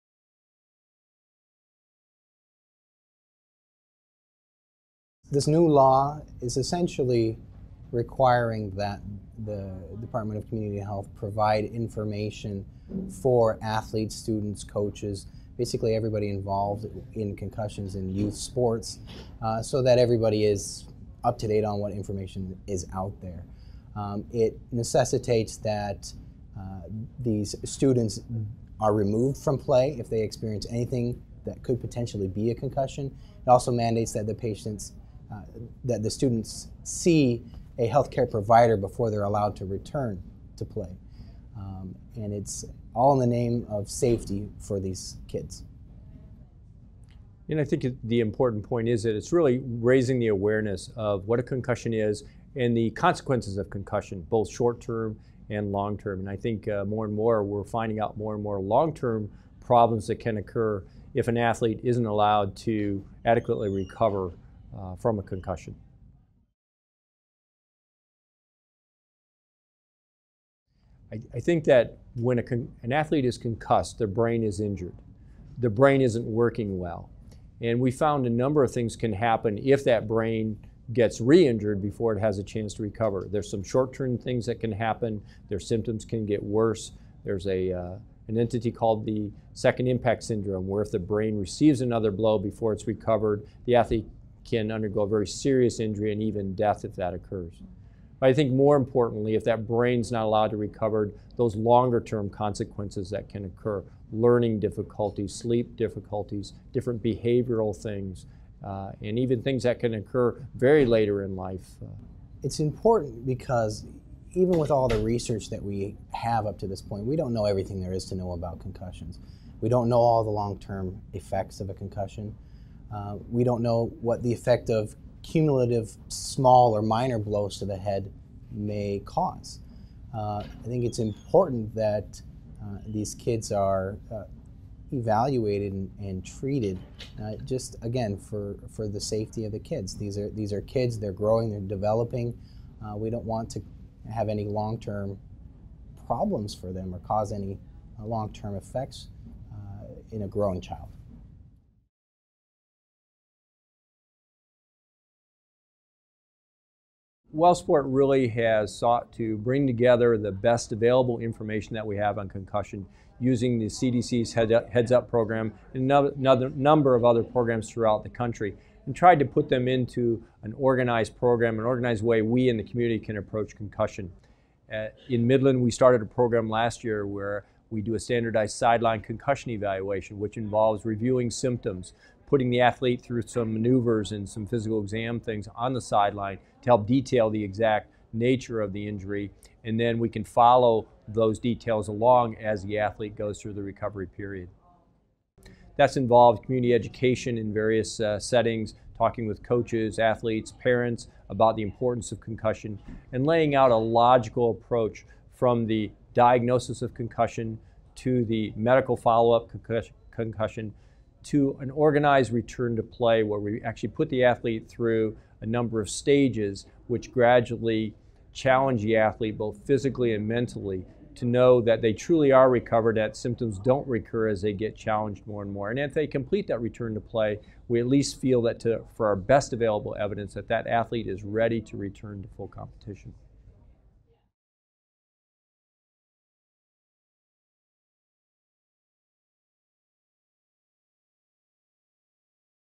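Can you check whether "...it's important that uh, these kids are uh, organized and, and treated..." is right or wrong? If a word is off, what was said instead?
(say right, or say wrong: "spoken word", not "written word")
wrong: "evaluated", not "organized".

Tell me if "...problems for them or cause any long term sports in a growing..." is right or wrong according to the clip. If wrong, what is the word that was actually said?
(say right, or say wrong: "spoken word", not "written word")
wrong: "effects", not "sports".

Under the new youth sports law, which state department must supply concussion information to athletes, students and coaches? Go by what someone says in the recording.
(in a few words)
Department of Community Health.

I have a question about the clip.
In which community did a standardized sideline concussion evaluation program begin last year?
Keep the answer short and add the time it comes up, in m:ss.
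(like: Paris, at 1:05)
Midland, at 2:55.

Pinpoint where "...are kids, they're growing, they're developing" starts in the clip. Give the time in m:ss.
2:20.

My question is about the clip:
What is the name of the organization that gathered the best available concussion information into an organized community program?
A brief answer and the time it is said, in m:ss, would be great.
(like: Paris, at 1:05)
Wellsport, at 2:37.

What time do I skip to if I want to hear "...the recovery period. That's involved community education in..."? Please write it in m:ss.
3:13.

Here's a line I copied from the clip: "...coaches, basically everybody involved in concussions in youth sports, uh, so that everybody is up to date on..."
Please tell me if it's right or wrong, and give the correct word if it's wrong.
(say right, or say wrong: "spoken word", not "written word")
right.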